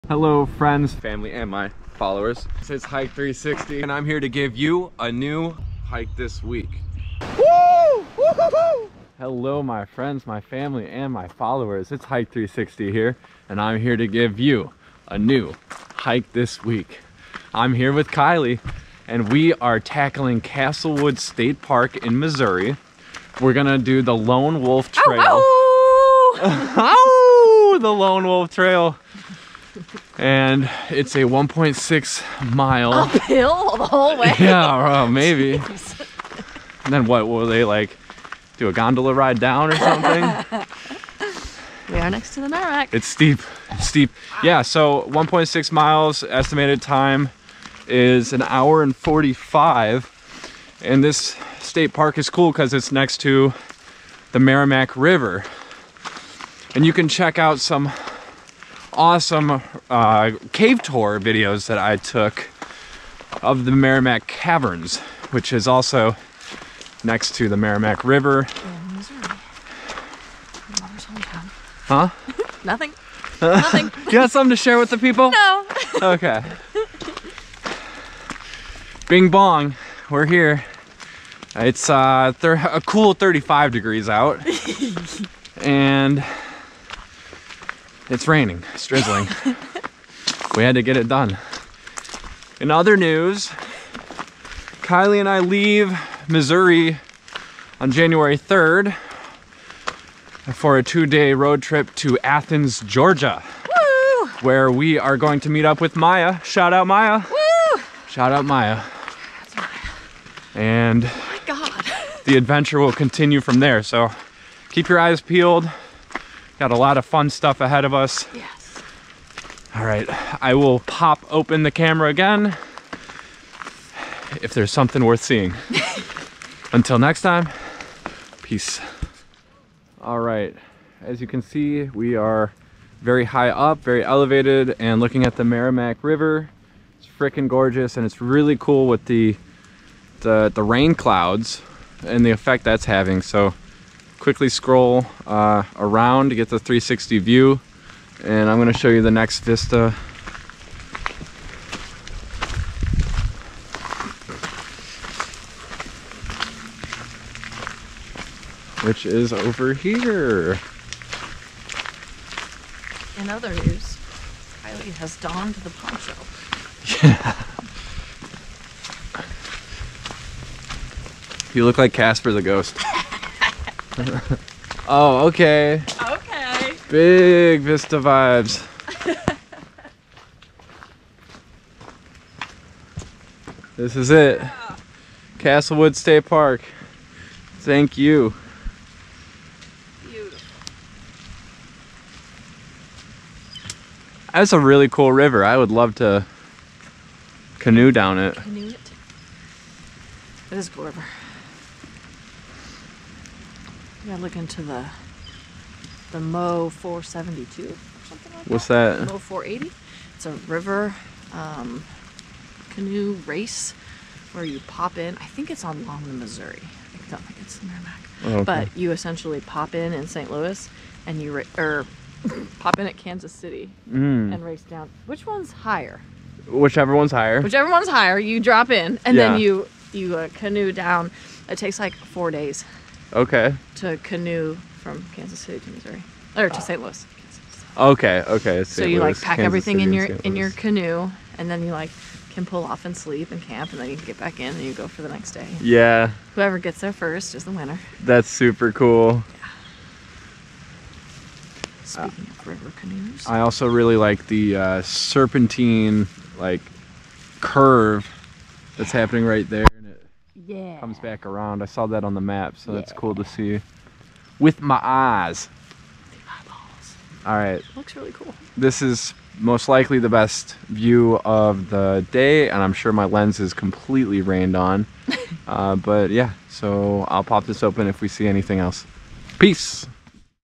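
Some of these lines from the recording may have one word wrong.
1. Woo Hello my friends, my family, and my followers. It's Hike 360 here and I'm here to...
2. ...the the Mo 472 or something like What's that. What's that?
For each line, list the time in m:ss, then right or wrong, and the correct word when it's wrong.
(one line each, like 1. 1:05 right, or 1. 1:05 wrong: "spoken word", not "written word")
1. 0:08 right
2. 3:24 right.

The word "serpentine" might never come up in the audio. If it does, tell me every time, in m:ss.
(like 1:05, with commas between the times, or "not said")
4:14.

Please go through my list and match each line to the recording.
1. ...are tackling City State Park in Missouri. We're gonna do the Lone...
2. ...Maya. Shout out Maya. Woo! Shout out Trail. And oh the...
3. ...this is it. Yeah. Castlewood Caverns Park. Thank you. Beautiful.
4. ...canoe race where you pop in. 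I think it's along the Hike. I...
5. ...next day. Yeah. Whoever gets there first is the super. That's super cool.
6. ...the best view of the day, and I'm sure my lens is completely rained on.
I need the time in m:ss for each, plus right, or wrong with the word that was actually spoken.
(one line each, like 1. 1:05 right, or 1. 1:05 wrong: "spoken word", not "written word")
1. 0:19 wrong: "Castlewood", not "City"
2. 1:45 wrong: "Maya", not "Trail"
3. 3:03 wrong: "State", not "Caverns"
4. 3:32 wrong: "Missouri", not "Hike"
5. 4:05 wrong: "winner", not "super"
6. 4:29 right.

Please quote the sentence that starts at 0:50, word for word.
And this state park is cool because it's next to the Meramec River.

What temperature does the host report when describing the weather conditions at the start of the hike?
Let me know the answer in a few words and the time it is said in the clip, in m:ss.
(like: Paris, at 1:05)
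35 degrees, at 1:23.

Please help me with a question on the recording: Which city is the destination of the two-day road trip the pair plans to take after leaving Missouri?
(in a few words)
Athens, Georgia.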